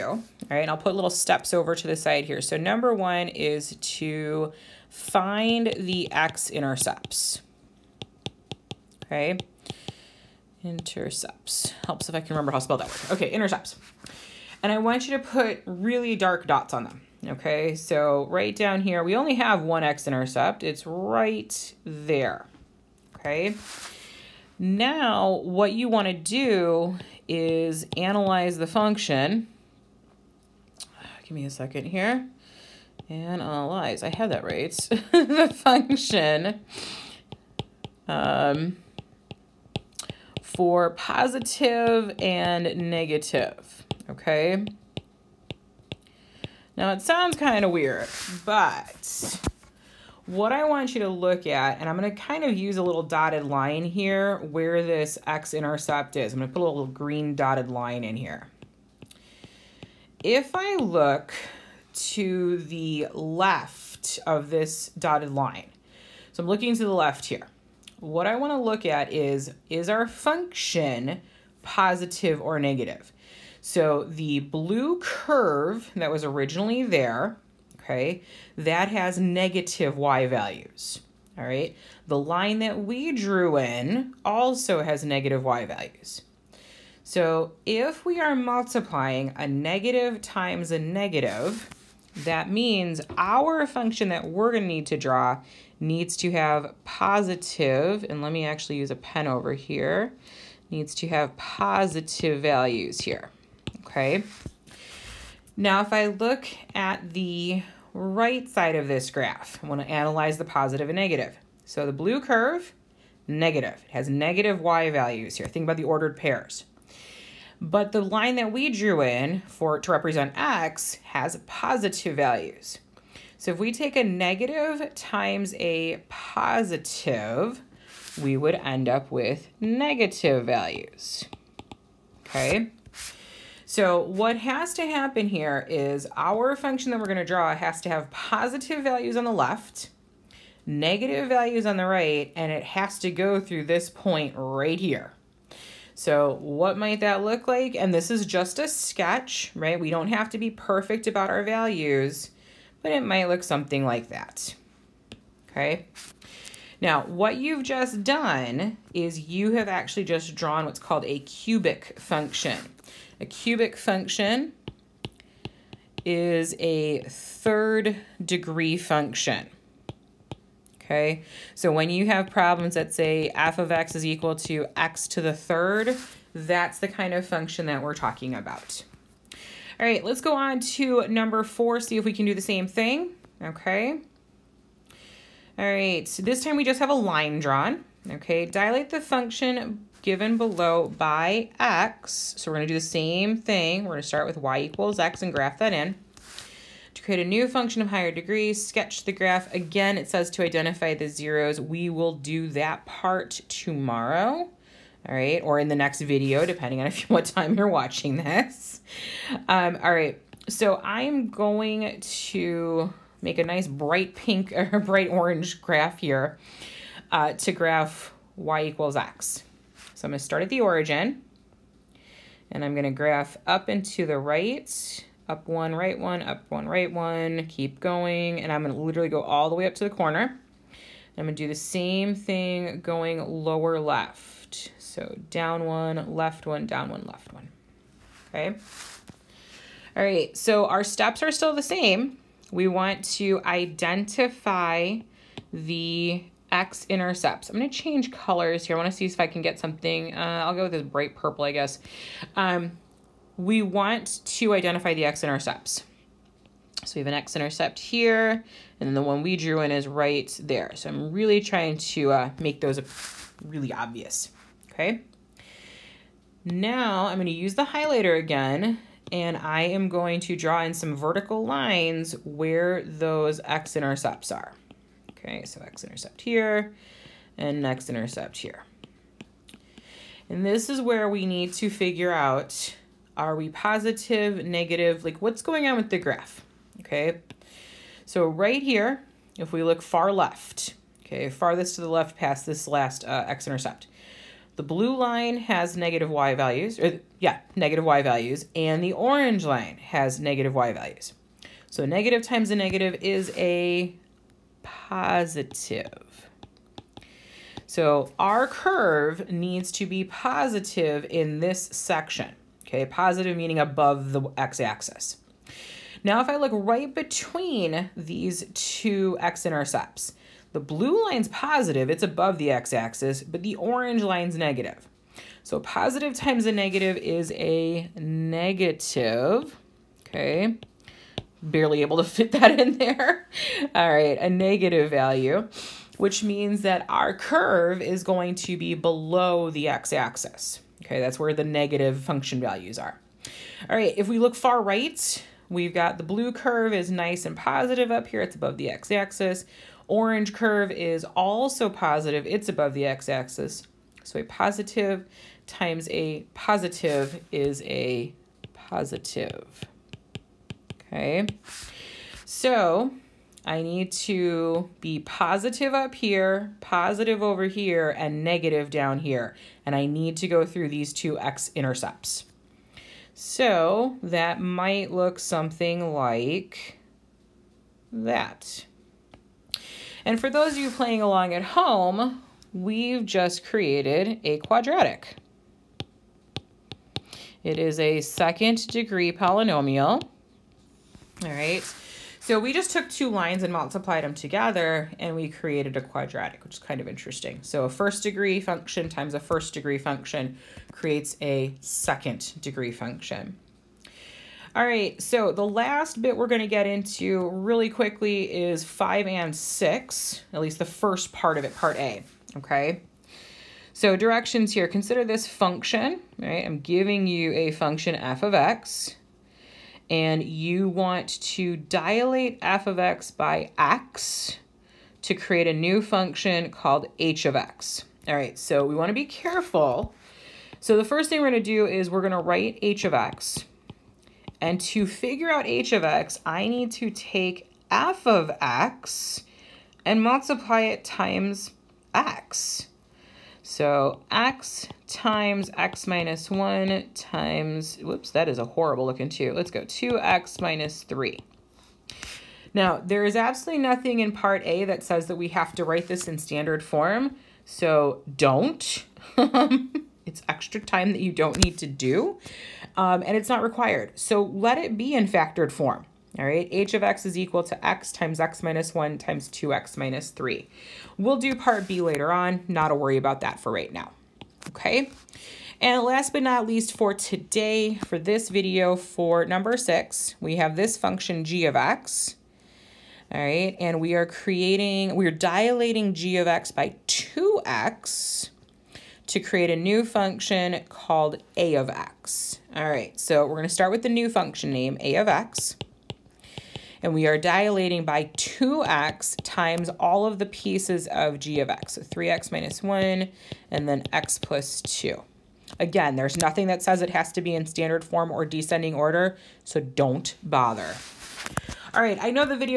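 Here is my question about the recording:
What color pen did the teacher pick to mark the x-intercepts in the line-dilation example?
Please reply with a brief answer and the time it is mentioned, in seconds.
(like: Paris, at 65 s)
bright purple, at 250 s.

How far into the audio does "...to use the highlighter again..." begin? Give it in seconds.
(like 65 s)
267 s.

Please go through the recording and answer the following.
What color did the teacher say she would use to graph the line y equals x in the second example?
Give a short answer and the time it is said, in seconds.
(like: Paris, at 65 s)
bright orange, at 214 s.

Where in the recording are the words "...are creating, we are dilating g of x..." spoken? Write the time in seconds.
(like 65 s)
483 s.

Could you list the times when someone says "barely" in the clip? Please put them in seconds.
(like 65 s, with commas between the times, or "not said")
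331 s.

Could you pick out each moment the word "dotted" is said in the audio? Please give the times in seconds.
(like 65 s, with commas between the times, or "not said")
53 s, 57 s, 64 s.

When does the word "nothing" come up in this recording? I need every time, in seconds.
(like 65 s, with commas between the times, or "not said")
453 s, 506 s.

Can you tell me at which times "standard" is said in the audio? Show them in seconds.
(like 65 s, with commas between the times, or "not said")
456 s, 507 s.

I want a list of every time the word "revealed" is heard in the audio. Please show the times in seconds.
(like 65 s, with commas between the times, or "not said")
not said.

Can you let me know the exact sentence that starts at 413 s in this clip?
So directions here, consider this function, right?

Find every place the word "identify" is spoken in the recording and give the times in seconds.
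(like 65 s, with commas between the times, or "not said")
200 s, 243 s, 254 s.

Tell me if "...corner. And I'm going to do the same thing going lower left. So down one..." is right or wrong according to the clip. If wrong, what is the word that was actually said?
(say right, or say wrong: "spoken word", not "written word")
right.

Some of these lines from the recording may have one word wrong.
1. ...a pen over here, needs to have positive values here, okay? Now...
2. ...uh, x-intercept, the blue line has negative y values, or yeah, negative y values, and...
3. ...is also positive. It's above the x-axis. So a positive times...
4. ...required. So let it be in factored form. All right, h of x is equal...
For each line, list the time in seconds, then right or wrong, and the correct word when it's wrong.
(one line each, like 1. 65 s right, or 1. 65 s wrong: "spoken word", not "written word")
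1. 98 s right
2. 293 s right
3. 350 s right
4. 463 s right.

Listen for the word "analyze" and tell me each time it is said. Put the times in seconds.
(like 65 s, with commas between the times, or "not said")
27 s, 33 s, 109 s.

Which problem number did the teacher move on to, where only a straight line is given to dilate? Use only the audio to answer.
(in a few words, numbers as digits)
4.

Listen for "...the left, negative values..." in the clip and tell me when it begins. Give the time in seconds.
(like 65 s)
139 s.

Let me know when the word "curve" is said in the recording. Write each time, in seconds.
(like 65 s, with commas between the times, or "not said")
74 s, 112 s, 308 s, 337 s, 346 s, 350 s.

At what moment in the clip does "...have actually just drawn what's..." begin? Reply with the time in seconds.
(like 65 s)
159 s.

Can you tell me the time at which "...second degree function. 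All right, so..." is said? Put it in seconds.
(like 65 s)
401 s.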